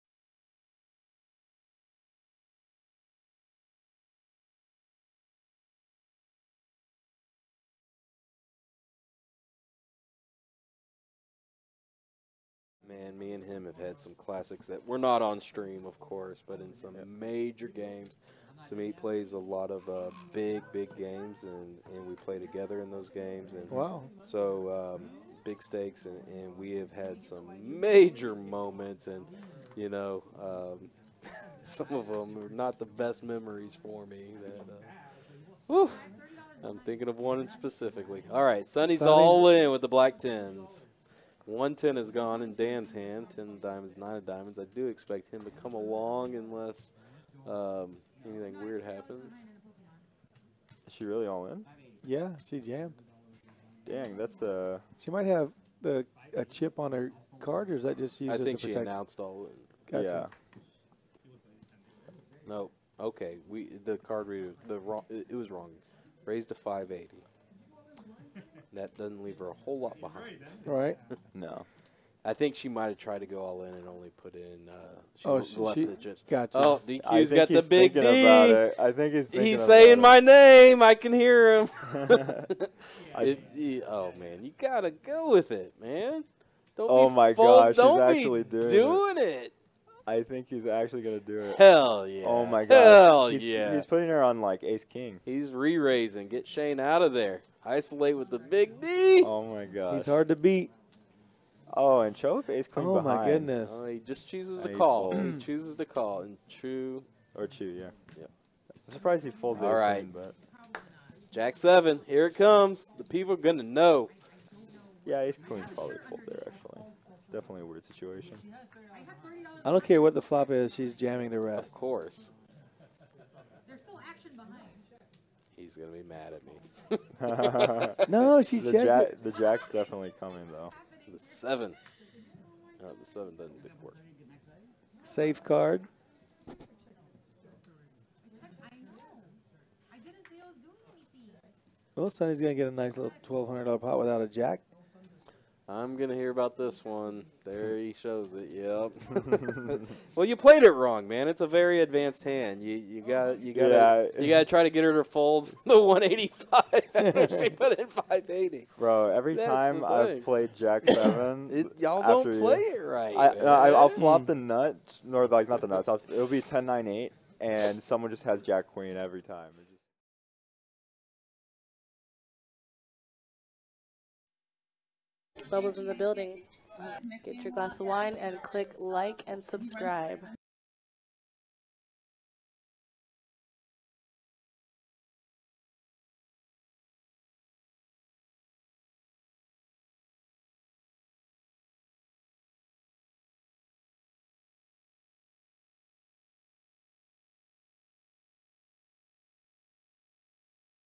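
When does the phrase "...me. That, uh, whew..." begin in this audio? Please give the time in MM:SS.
00:34.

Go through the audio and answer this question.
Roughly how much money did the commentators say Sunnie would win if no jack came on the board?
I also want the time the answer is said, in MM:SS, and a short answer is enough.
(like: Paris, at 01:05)
$1,200, at 02:23.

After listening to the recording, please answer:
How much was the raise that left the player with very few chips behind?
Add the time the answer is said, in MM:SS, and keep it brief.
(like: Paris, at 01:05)
580, at 01:06.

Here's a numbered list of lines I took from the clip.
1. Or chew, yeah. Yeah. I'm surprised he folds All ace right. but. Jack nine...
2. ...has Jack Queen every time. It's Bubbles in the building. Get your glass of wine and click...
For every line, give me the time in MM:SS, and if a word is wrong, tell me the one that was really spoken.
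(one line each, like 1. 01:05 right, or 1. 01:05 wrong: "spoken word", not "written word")
1. 01:47 wrong: "seven", not "nine"
2. 02:48 right.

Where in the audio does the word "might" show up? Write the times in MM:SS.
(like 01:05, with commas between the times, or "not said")
00:55, 01:12.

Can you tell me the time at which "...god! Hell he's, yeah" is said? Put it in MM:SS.
01:32.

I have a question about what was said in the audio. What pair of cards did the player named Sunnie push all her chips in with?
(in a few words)
Black Tens.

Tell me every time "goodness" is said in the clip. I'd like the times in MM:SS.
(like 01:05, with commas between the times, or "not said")
01:43.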